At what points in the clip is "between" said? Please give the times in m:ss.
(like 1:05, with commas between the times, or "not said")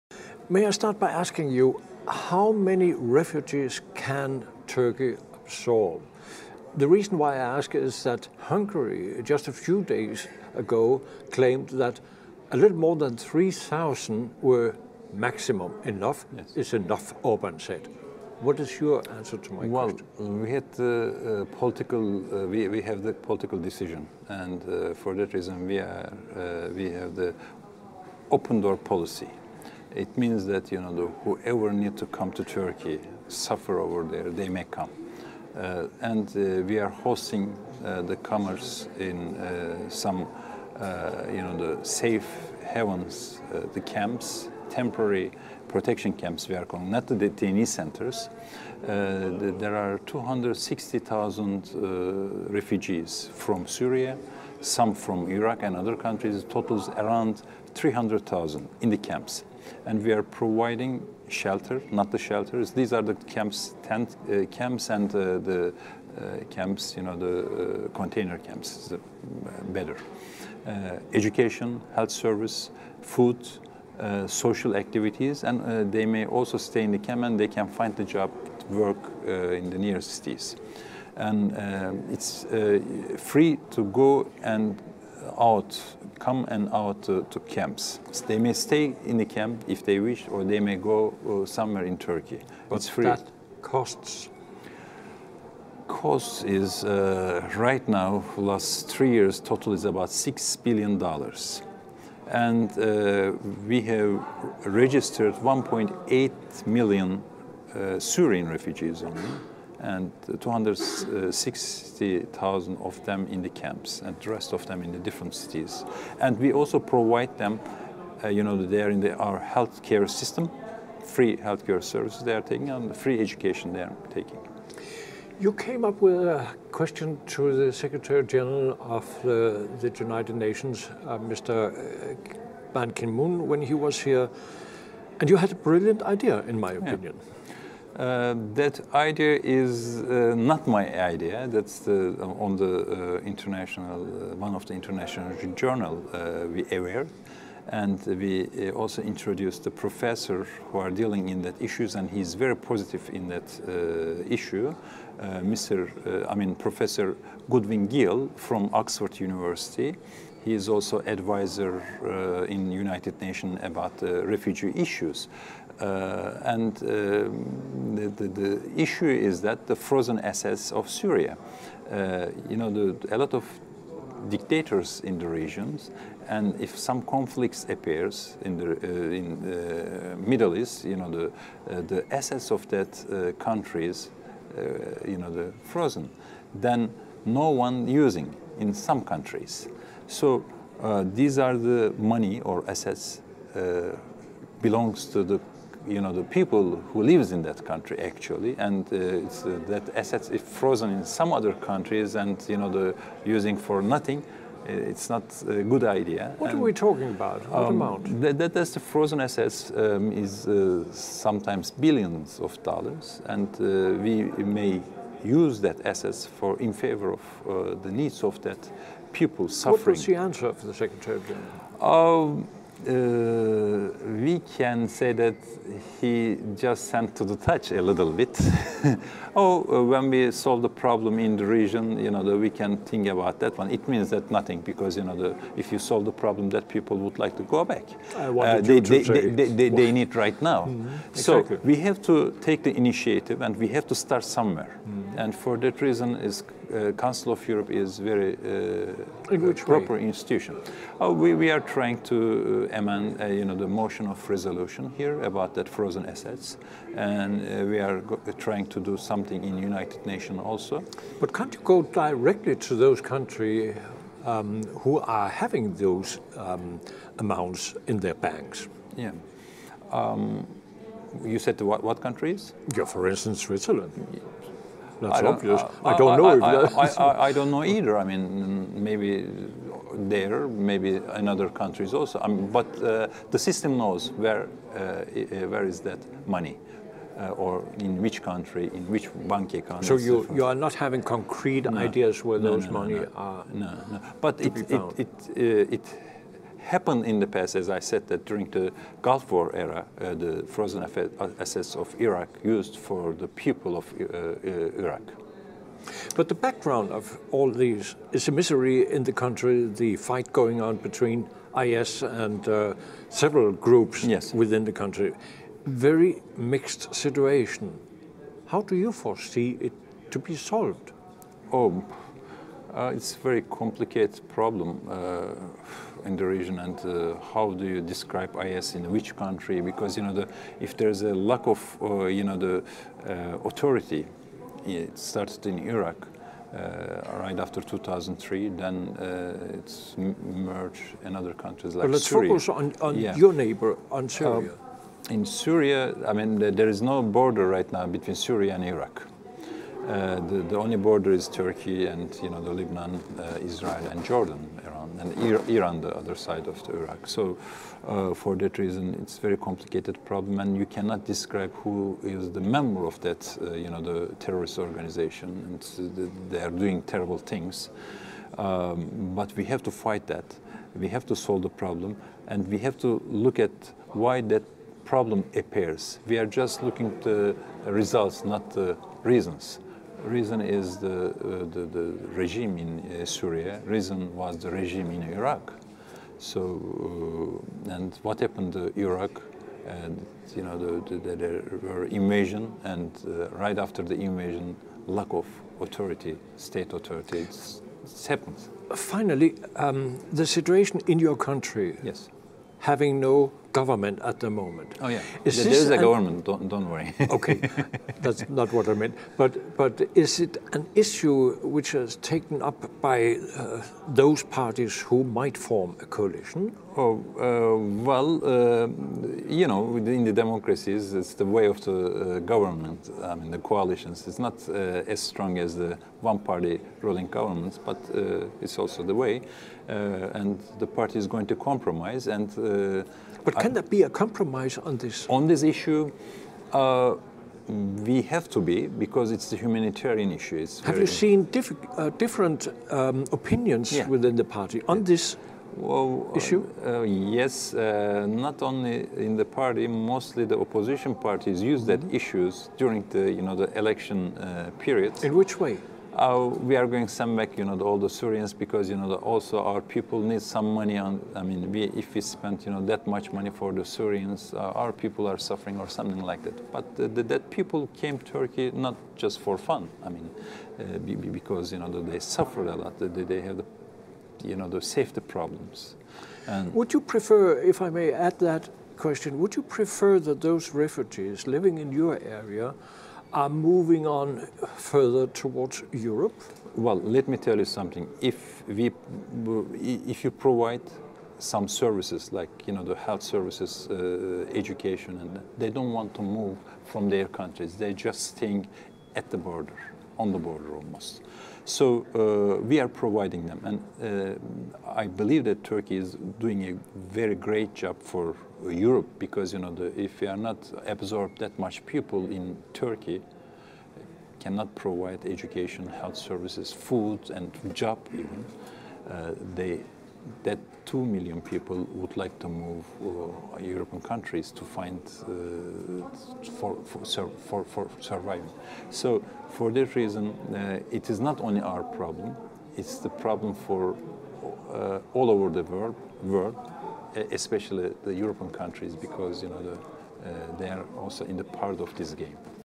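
5:10, 5:47.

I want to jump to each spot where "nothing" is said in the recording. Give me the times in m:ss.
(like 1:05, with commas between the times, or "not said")
3:23, 3:54.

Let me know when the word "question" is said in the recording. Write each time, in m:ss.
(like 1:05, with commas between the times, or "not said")
0:19, 2:06, 7:58.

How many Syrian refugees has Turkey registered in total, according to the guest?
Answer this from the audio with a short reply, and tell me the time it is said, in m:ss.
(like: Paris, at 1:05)
1.8 million, at 1:45.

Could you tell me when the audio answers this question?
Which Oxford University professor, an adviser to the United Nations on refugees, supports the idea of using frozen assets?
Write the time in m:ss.
2:37.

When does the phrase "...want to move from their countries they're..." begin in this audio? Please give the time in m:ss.
8:15.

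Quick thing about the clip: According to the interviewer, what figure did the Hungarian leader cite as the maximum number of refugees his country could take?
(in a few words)
a little more than 3,000.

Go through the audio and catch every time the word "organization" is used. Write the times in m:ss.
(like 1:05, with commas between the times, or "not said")
6:04.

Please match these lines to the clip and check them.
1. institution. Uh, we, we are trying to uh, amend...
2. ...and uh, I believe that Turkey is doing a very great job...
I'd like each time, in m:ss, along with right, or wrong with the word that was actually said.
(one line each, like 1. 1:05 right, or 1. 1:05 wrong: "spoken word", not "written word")
1. 4:10 right
2. 8:23 right.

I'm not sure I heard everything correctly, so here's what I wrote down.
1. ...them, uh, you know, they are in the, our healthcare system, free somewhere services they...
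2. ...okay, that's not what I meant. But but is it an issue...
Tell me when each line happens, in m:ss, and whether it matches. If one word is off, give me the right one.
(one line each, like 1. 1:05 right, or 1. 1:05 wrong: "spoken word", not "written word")
1. 1:57 wrong: "healthcare", not "somewhere"
2. 6:47 right.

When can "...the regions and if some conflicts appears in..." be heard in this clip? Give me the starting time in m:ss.
2:55.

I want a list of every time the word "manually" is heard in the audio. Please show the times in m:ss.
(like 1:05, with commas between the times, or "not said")
not said.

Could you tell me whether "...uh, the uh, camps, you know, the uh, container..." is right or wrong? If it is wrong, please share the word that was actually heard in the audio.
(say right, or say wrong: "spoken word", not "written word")
right.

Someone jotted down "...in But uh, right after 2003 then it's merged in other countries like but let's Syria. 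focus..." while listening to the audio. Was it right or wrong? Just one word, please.
wrong.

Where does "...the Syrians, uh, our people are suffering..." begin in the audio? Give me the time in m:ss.
7:43.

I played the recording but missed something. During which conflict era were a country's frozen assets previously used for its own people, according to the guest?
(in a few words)
Gulf War.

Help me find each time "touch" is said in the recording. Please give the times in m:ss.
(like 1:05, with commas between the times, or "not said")
3:47.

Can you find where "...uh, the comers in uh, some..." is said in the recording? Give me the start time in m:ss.
0:37.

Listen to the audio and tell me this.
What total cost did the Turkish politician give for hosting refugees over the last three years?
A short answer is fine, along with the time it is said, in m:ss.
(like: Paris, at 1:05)
six billion dollars, at 1:40.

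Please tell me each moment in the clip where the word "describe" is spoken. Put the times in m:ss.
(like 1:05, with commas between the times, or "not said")
5:27, 6:01.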